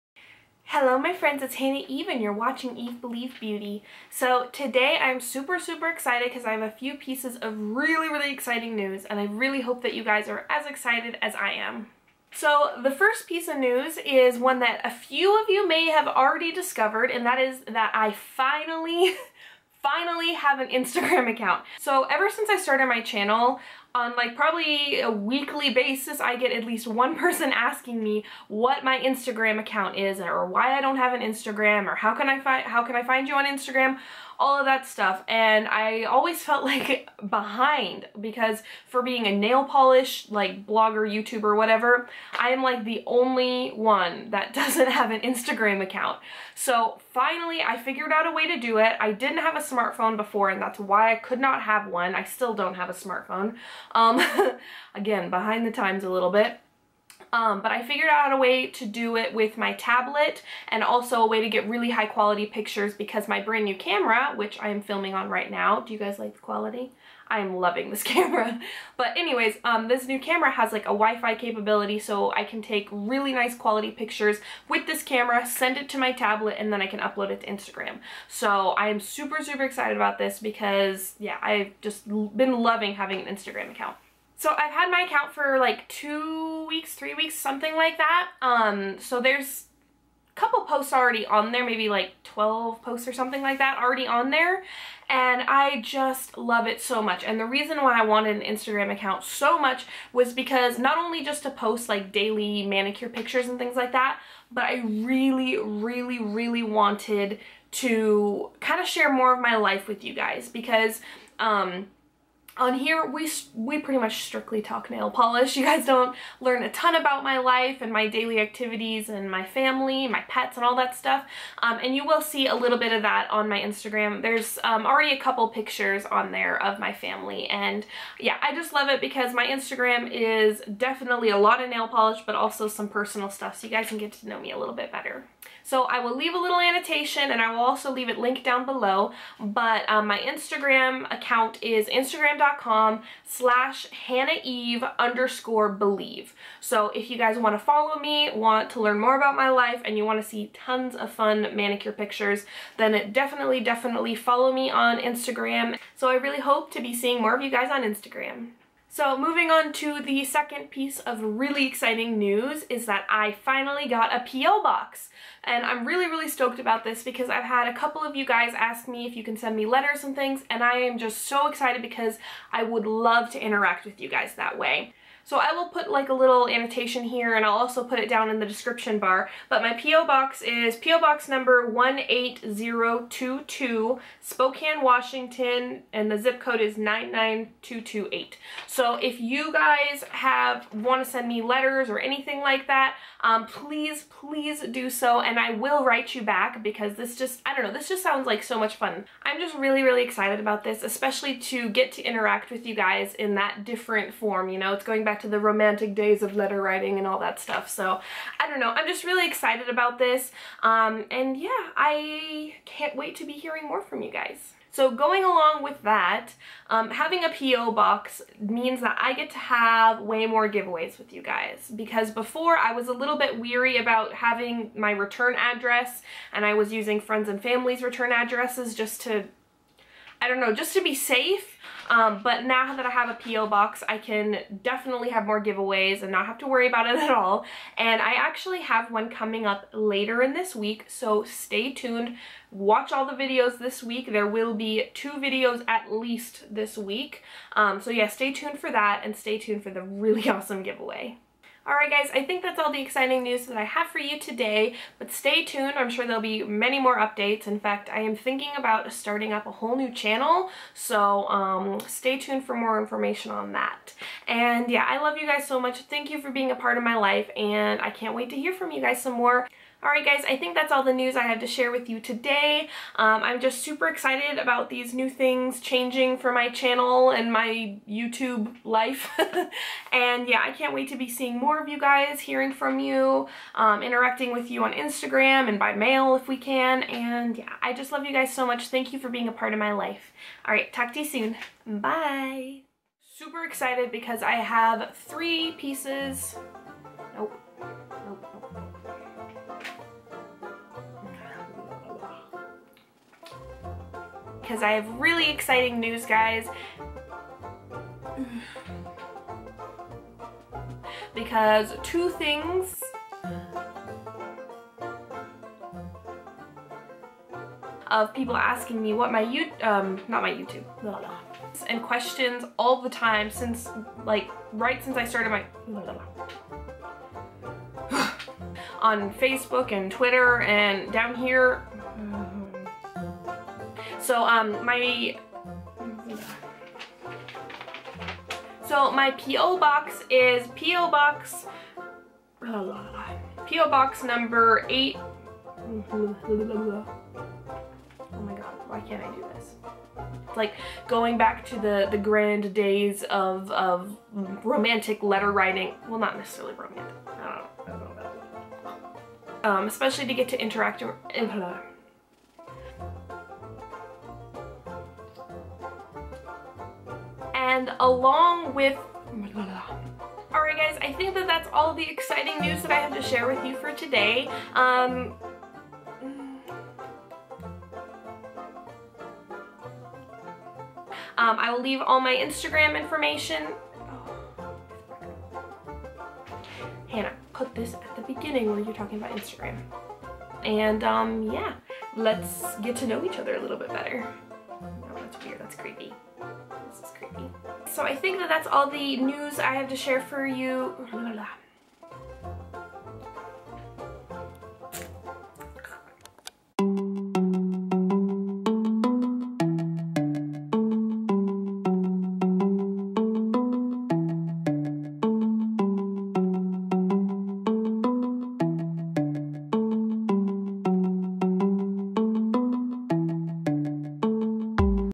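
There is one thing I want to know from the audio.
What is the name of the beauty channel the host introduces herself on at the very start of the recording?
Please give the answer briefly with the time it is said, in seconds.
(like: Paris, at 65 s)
Eve Believe Beauty, at 2 s.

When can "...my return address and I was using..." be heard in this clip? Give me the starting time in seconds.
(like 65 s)
224 s.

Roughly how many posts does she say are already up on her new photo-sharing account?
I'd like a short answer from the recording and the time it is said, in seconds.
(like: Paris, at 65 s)
12, at 92 s.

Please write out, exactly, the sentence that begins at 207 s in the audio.
So I don't know, I'm just really excited about this.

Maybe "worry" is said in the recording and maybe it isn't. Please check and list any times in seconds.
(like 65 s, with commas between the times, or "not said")
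236 s.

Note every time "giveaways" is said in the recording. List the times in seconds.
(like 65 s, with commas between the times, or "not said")
220 s, 235 s, 250 s.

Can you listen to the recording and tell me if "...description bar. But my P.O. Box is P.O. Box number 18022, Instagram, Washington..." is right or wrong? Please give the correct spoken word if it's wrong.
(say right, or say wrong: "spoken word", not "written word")
wrong: "Spokane", not "Instagram".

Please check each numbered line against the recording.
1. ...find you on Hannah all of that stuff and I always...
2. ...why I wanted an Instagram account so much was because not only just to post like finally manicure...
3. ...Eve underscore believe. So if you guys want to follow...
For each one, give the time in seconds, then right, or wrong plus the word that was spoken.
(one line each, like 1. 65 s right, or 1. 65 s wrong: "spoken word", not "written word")
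1. 33 s wrong: "Instagram", not "Hannah"
2. 97 s wrong: "daily", not "finally"
3. 144 s right.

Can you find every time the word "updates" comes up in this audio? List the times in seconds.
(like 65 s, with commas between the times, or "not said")
256 s.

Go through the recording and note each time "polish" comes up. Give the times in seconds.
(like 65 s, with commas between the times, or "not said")
39 s, 115 s, 131 s.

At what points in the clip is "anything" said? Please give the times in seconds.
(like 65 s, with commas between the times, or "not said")
191 s.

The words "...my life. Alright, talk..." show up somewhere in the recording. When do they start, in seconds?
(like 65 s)
289 s.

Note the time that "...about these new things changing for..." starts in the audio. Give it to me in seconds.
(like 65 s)
274 s.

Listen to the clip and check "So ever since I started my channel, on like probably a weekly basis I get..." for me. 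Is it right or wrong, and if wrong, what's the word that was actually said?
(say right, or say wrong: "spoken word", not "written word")
right.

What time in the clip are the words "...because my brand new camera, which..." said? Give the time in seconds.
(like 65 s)
62 s.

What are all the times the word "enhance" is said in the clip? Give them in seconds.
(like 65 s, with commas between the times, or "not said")
not said.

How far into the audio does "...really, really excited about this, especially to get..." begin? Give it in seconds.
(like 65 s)
199 s.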